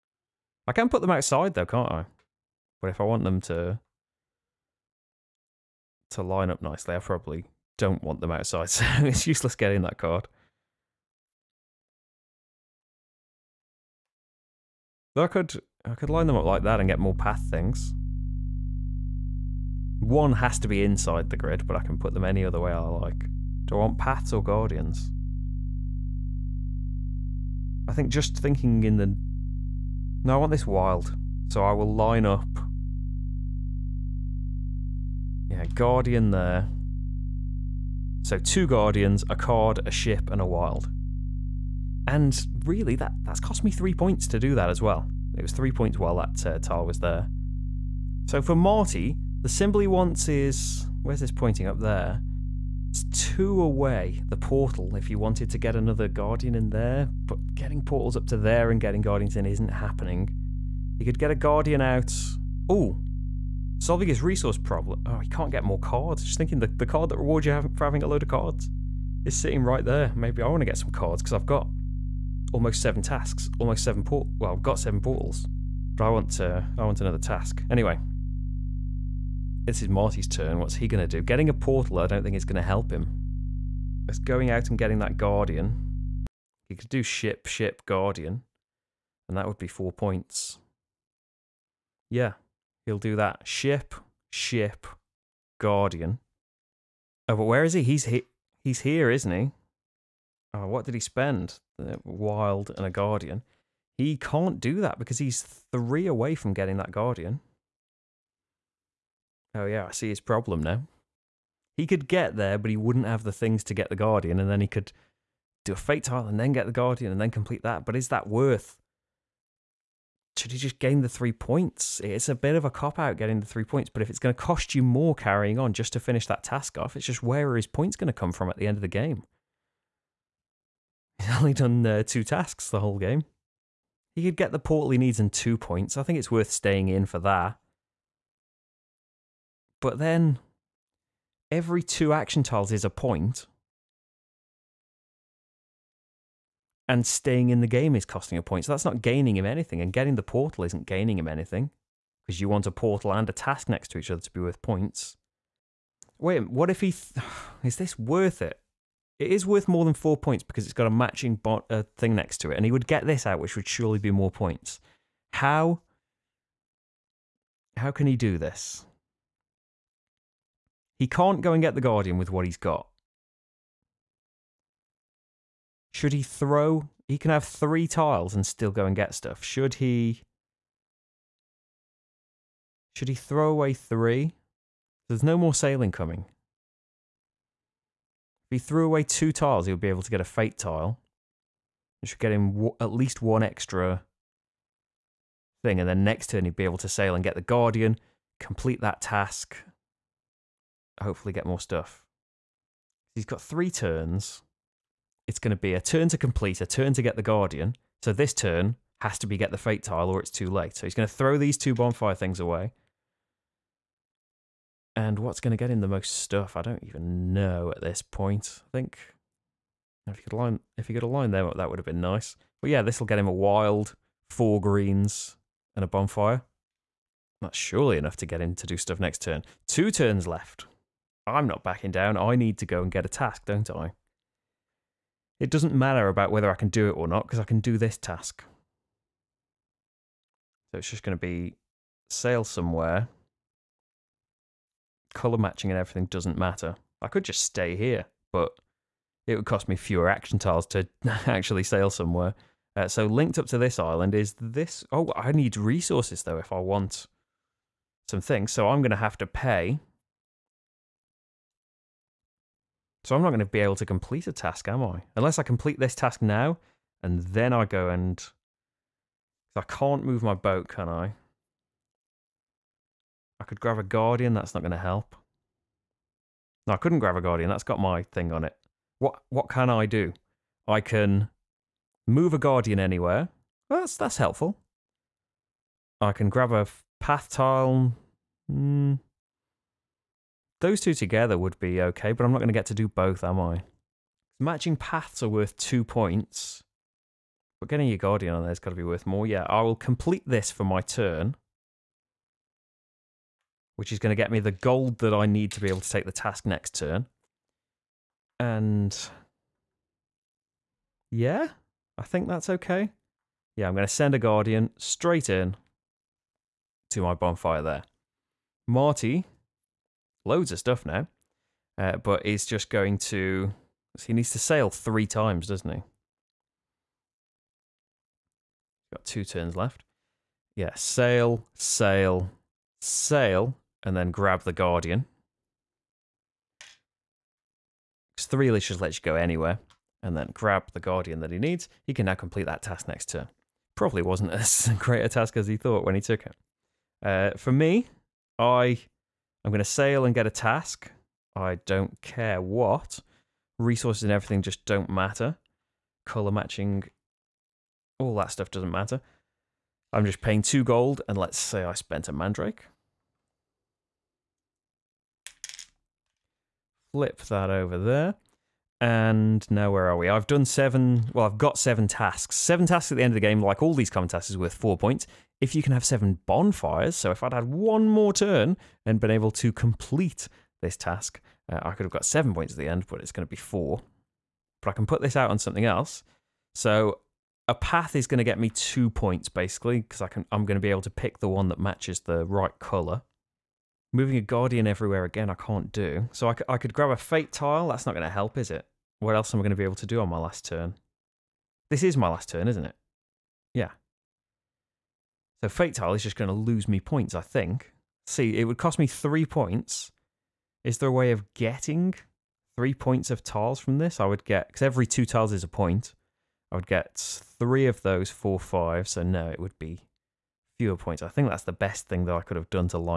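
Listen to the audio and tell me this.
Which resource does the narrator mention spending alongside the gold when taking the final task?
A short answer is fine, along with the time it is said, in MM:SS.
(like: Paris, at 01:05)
Mandrake, at 06:02.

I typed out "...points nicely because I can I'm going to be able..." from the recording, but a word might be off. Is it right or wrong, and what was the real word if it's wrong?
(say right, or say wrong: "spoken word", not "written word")
wrong: "basically", not "nicely".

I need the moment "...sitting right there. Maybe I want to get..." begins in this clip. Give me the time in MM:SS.
01:09.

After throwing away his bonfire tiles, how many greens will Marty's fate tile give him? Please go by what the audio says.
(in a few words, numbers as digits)
4.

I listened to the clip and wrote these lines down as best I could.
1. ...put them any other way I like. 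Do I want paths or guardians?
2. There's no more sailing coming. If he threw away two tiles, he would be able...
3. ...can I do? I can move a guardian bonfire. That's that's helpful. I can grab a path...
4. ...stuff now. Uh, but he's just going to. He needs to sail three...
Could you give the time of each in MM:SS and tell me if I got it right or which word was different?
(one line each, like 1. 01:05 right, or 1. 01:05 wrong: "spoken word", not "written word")
1. 00:21 right
2. 03:05 right
3. 04:39 wrong: "anywhere", not "bonfire"
4. 05:20 right.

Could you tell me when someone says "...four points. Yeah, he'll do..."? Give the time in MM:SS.
01:29.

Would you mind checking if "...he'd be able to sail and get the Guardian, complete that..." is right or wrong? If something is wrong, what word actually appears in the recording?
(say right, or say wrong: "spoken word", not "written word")
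right.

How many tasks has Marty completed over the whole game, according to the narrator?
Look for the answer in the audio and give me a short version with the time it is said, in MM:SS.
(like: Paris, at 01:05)
2, at 02:12.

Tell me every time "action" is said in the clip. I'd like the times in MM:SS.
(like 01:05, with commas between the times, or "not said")
02:22, 04:10.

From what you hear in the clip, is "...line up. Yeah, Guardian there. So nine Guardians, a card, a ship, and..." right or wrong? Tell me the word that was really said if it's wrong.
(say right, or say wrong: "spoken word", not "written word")
wrong: "two", not "nine".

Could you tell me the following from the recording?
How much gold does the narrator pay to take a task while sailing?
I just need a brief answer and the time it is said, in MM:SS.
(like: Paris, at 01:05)
2 gold, at 06:00.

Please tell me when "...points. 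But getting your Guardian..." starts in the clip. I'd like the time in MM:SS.
04:55.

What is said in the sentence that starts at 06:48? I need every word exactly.
See, it would cost me three points.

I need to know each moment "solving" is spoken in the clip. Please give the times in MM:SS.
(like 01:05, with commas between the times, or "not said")
01:03.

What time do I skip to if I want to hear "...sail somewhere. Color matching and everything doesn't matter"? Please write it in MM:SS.
04:02.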